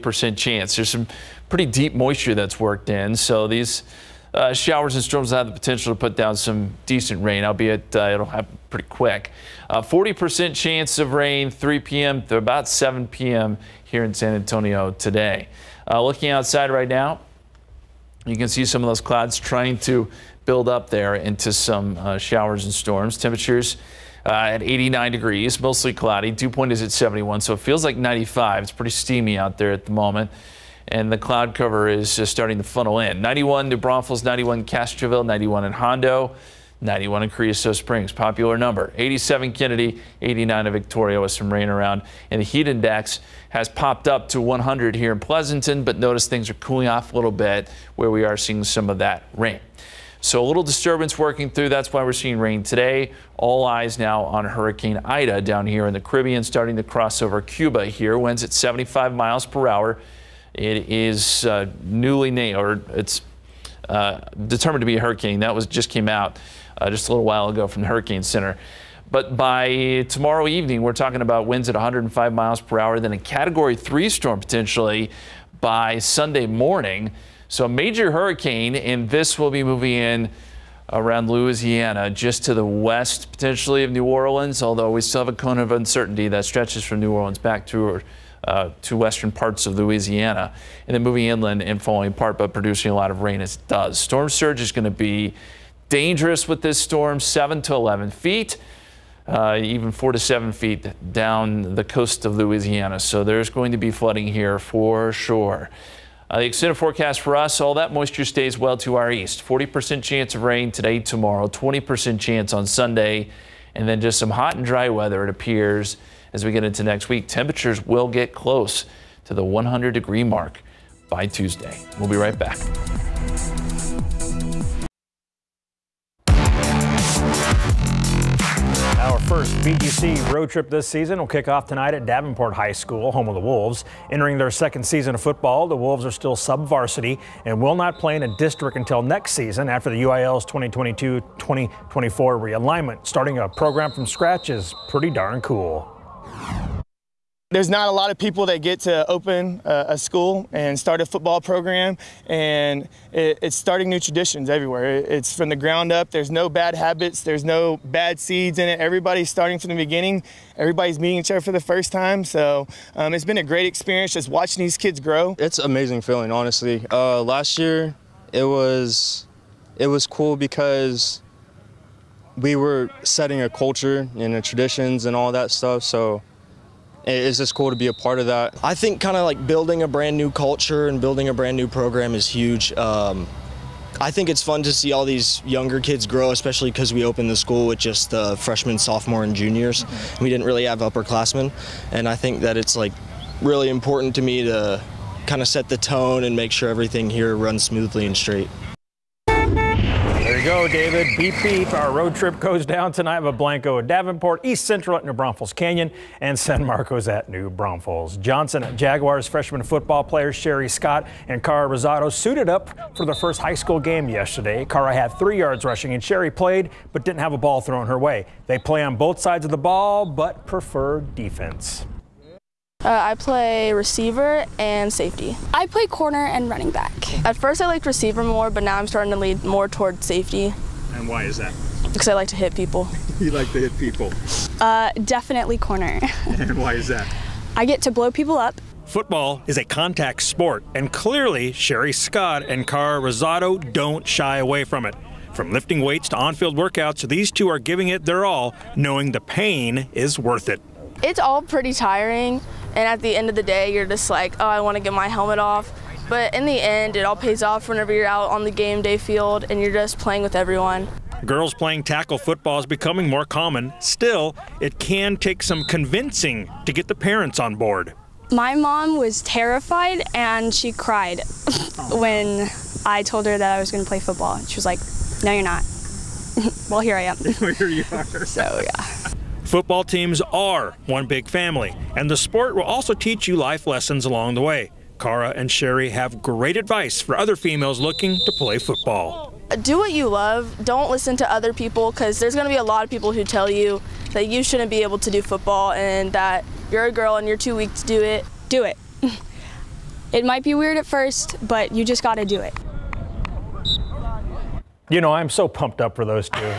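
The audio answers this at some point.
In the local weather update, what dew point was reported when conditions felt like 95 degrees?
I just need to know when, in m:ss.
0:26.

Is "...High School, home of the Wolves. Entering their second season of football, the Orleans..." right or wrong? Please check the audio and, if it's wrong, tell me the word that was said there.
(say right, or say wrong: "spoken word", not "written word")
wrong: "Wolves", not "Orleans".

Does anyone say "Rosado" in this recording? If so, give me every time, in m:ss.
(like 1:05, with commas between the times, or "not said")
3:31, 4:03.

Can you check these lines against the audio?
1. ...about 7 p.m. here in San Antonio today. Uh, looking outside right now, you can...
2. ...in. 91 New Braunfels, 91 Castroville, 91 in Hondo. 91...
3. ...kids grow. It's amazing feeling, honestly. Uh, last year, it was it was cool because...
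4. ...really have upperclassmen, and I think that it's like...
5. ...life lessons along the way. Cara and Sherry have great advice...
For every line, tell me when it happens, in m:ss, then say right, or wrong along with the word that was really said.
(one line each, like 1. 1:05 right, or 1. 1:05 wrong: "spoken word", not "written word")
1. 0:12 right
2. 0:32 right
3. 2:44 right
4. 3:10 right
5. 4:43 right.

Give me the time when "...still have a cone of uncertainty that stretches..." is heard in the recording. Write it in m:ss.
1:25.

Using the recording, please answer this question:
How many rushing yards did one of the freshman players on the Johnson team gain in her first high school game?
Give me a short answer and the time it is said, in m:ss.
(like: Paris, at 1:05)
3, at 3:35.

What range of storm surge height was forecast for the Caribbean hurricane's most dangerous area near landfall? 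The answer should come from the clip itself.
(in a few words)
7 to 11 feet.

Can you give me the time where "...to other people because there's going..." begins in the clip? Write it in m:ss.
4:51.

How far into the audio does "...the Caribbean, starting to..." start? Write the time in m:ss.
0:55.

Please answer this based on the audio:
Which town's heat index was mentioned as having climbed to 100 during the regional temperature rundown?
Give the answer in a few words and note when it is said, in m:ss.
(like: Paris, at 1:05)
Pleasanton, at 0:45.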